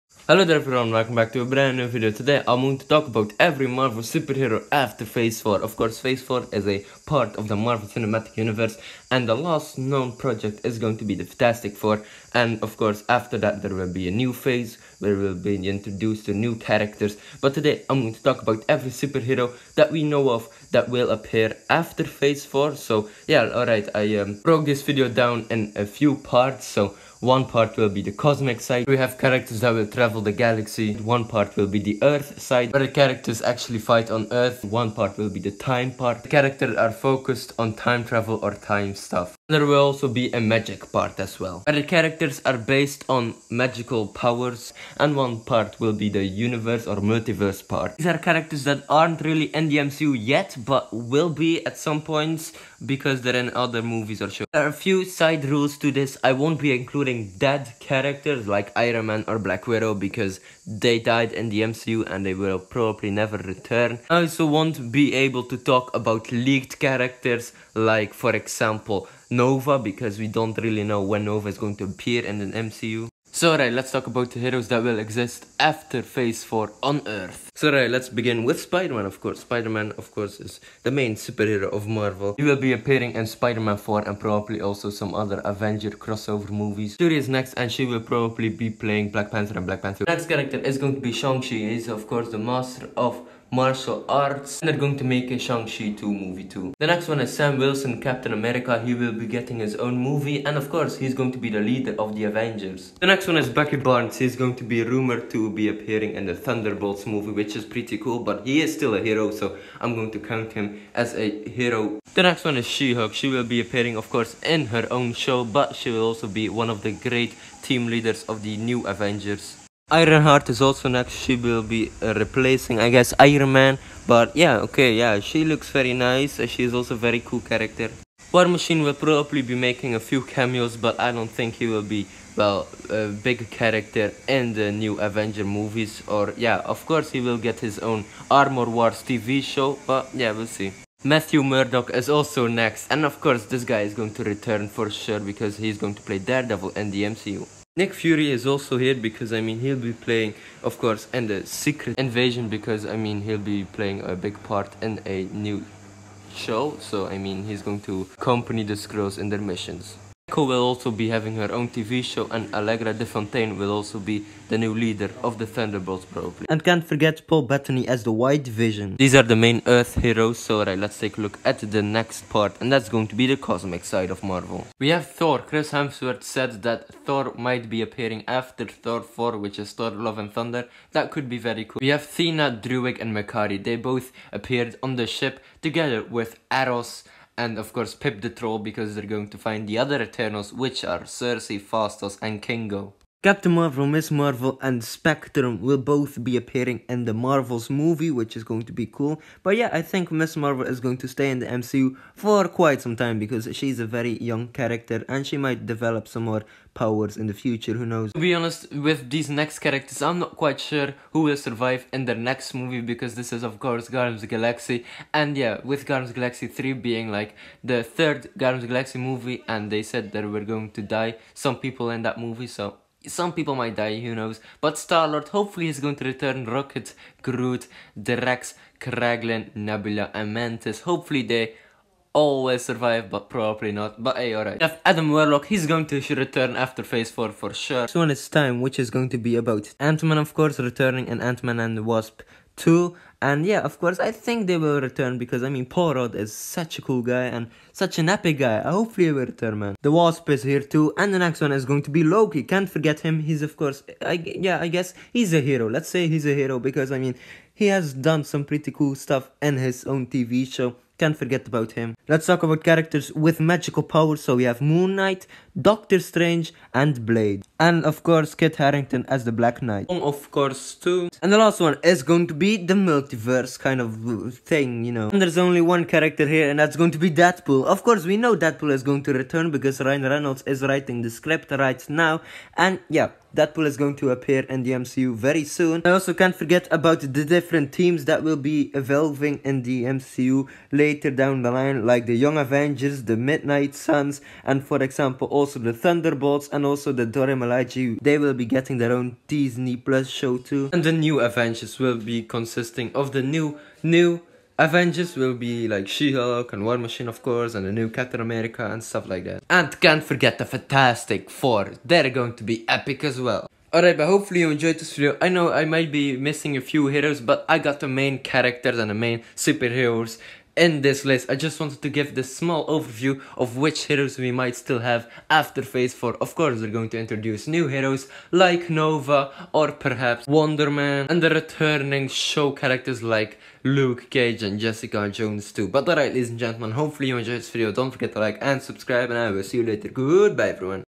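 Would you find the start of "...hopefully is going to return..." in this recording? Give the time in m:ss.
3:45.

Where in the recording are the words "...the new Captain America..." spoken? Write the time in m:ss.
5:07.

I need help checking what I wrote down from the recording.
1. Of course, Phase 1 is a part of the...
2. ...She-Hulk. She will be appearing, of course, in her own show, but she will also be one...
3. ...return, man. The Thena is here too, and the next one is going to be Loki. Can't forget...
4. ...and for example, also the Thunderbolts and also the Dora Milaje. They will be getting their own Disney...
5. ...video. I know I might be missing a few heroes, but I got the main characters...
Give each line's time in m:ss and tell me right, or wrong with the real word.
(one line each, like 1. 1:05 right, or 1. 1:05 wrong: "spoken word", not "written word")
1. 0:05 wrong: "4", not "1"
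2. 1:52 right
3. 4:09 wrong: "Wasp", not "Thena"
4. 4:54 right
5. 5:14 right.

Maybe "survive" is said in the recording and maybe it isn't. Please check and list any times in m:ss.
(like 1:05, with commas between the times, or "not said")
3:31, 3:52.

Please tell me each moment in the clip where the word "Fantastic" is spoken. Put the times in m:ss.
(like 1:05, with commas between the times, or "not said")
0:11, 5:10.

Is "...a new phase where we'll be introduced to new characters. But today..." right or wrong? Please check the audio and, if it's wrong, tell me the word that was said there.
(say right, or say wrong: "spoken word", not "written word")
right.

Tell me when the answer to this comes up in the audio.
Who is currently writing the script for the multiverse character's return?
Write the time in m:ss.
4:39.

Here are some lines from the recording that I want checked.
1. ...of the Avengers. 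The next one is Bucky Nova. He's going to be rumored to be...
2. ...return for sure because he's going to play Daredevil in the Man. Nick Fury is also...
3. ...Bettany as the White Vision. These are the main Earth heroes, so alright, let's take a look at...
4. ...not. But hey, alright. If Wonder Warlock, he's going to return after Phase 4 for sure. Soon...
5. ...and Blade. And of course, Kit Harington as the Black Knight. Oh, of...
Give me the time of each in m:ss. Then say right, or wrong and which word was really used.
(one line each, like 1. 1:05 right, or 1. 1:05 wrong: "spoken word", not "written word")
1. 1:41 wrong: "Barnes", not "Nova"
2. 2:24 wrong: "MCU", not "Man"
3. 2:47 right
4. 3:53 wrong: "Adam", not "Wonder"
5. 4:26 right.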